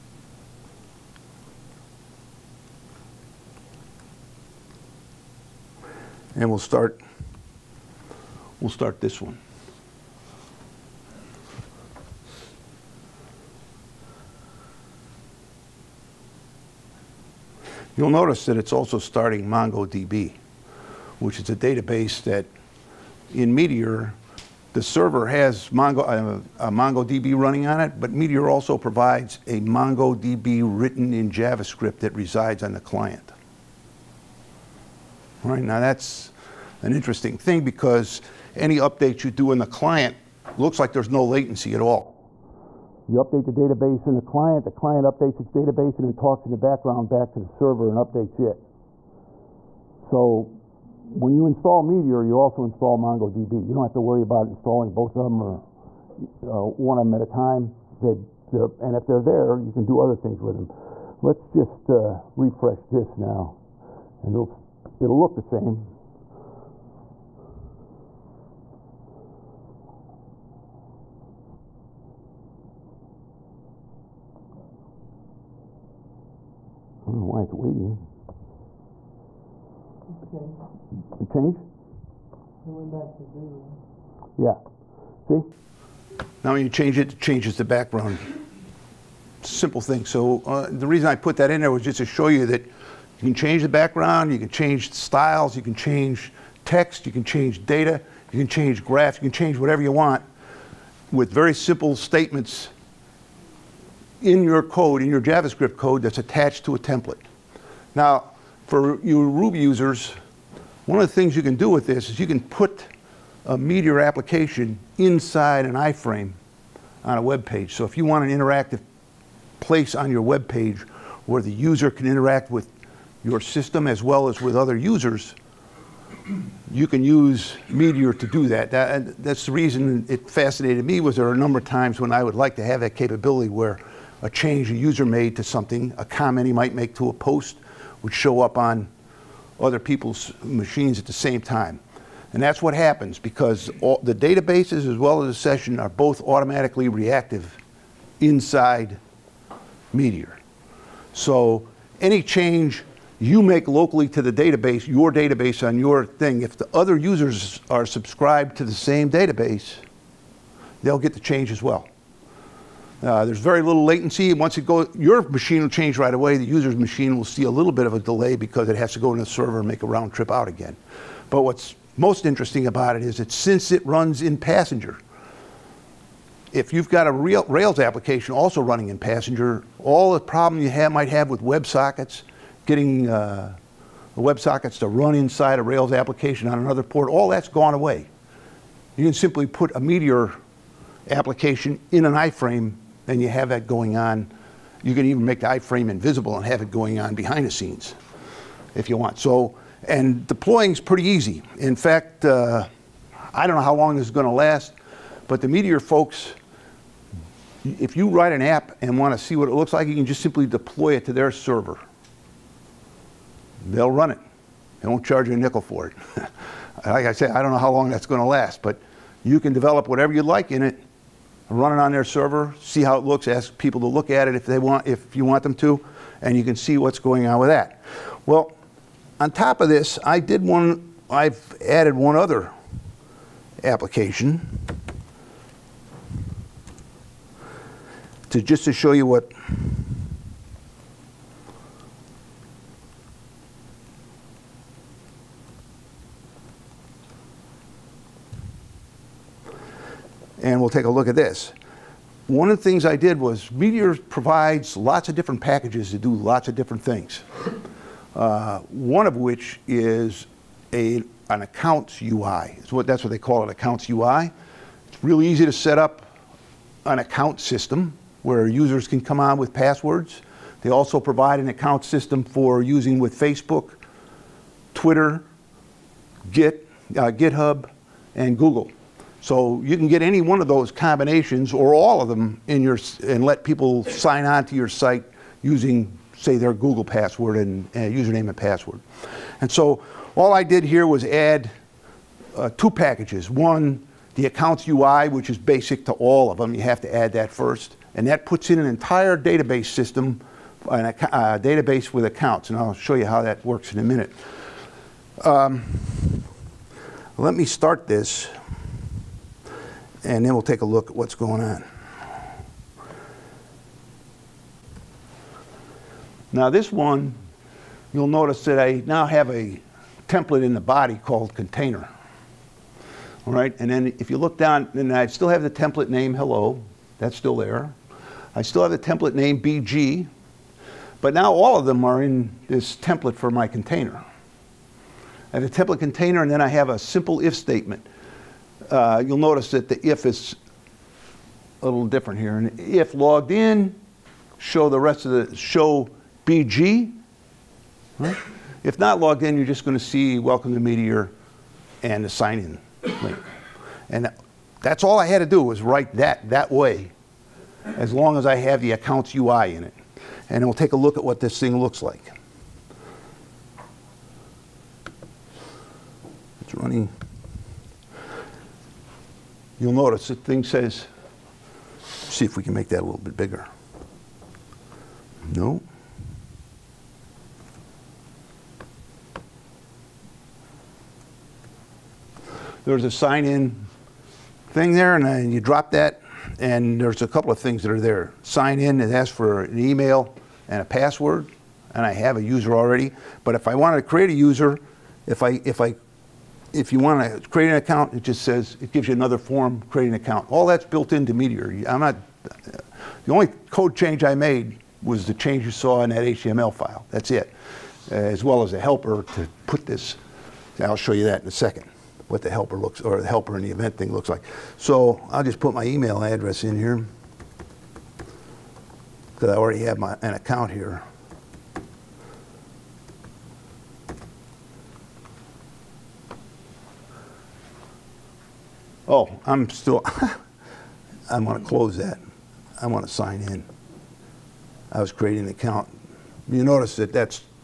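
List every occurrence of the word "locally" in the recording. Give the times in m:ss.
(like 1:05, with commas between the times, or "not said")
2:33.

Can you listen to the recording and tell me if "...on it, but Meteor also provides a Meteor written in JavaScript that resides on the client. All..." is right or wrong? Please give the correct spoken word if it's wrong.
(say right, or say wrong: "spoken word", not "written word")
wrong: "MongoDB", not "Meteor".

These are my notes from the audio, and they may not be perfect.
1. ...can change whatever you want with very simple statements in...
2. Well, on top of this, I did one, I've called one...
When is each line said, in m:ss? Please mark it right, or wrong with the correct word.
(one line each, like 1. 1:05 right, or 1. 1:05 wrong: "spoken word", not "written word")
1. 1:39 right
2. 3:48 wrong: "added", not "called".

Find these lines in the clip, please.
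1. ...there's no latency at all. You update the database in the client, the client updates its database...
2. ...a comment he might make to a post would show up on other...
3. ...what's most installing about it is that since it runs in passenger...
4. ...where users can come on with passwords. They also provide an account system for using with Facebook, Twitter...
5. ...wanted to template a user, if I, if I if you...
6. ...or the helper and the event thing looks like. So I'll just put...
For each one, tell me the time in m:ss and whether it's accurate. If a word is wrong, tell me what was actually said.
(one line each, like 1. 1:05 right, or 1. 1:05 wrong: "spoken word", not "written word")
1. 0:40 right
2. 2:15 right
3. 2:51 wrong: "interesting", not "installing"
4. 4:28 right
5. 6:33 wrong: "create", not "template"
6. 6:52 right.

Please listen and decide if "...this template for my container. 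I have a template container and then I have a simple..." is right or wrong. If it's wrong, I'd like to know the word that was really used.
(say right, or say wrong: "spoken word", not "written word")
right.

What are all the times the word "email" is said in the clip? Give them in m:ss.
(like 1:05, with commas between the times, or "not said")
6:29, 6:55.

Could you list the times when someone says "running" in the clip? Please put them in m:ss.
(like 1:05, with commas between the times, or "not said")
0:27, 2:58, 6:06.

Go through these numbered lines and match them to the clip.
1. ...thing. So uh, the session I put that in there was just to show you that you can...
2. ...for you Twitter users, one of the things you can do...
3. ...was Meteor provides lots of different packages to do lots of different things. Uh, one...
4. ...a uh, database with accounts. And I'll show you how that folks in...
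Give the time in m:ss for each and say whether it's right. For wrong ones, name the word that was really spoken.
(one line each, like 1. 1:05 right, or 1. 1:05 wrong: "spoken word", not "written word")
1. 1:29 wrong: "reason", not "session"
2. 1:48 wrong: "Ruby", not "Twitter"
3. 4:13 right
4. 5:00 wrong: "works", not "folks".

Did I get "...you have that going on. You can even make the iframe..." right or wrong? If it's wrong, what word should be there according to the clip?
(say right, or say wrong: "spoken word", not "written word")
right.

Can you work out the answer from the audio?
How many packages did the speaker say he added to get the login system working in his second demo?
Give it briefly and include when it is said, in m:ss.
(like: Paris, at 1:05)
2, at 4:52.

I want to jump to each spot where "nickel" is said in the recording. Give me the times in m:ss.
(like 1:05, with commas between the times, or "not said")
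3:35.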